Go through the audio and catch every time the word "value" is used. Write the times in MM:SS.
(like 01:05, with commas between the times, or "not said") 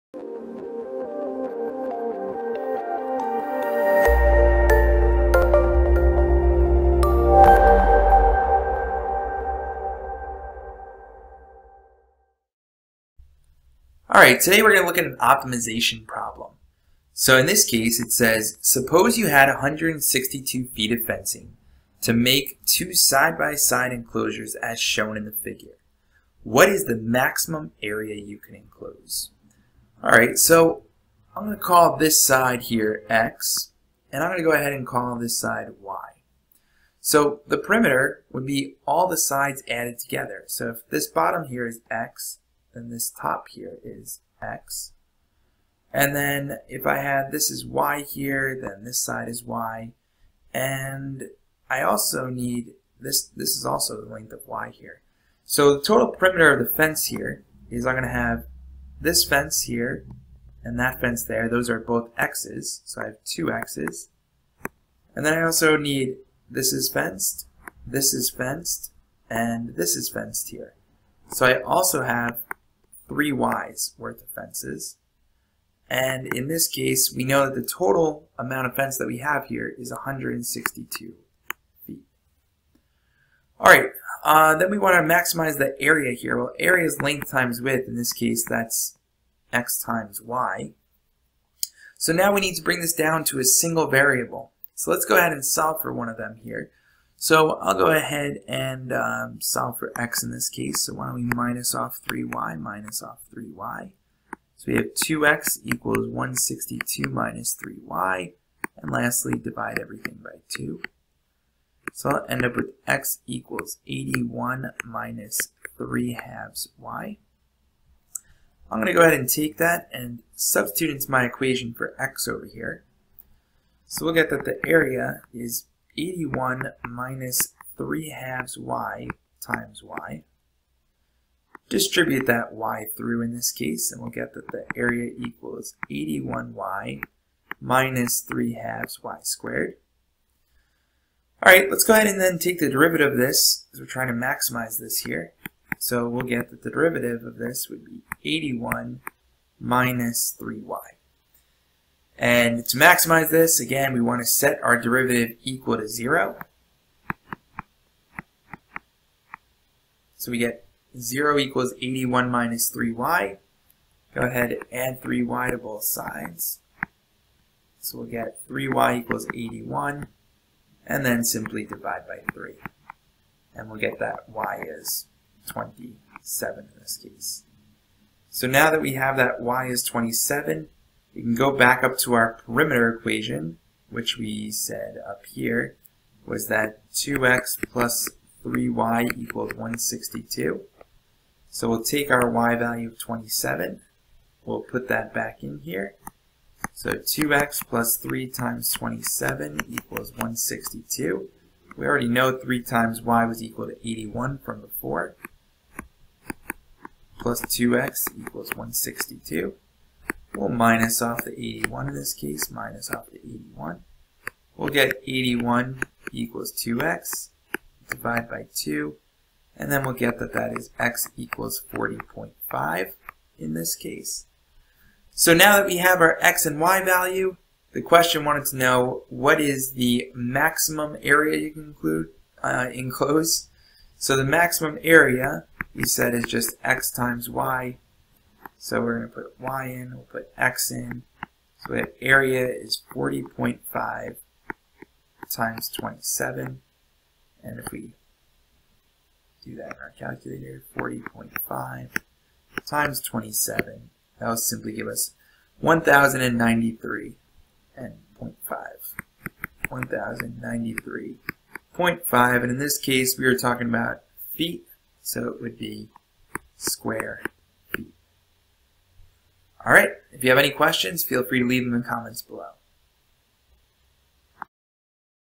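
03:12, 03:46.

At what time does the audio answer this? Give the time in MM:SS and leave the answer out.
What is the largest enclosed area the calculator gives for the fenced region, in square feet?
04:19.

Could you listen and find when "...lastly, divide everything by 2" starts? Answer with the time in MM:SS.
01:48.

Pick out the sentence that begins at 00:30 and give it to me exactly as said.
All right, so I'm going to call this side here X, and I'm going to go ahead and call this side Y.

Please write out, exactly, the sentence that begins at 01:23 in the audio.
All right, uh, then we want to maximize the area here.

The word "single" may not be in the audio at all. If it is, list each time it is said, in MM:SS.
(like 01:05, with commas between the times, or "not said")
01:33.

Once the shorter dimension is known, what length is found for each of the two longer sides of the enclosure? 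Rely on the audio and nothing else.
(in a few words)
40.5.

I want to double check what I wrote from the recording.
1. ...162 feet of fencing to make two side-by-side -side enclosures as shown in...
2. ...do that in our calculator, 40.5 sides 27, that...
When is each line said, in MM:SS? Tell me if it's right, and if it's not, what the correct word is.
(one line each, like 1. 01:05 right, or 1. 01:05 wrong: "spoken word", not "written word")
1. 00:19 right
2. 04:09 wrong: "times", not "sides".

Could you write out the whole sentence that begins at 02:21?
All right, let's go ahead and then take the derivative of this, because we're trying to maximize this here.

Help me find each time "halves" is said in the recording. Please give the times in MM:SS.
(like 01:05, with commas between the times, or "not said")
01:56, 02:08, 02:18.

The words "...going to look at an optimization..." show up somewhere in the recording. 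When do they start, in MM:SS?
00:14.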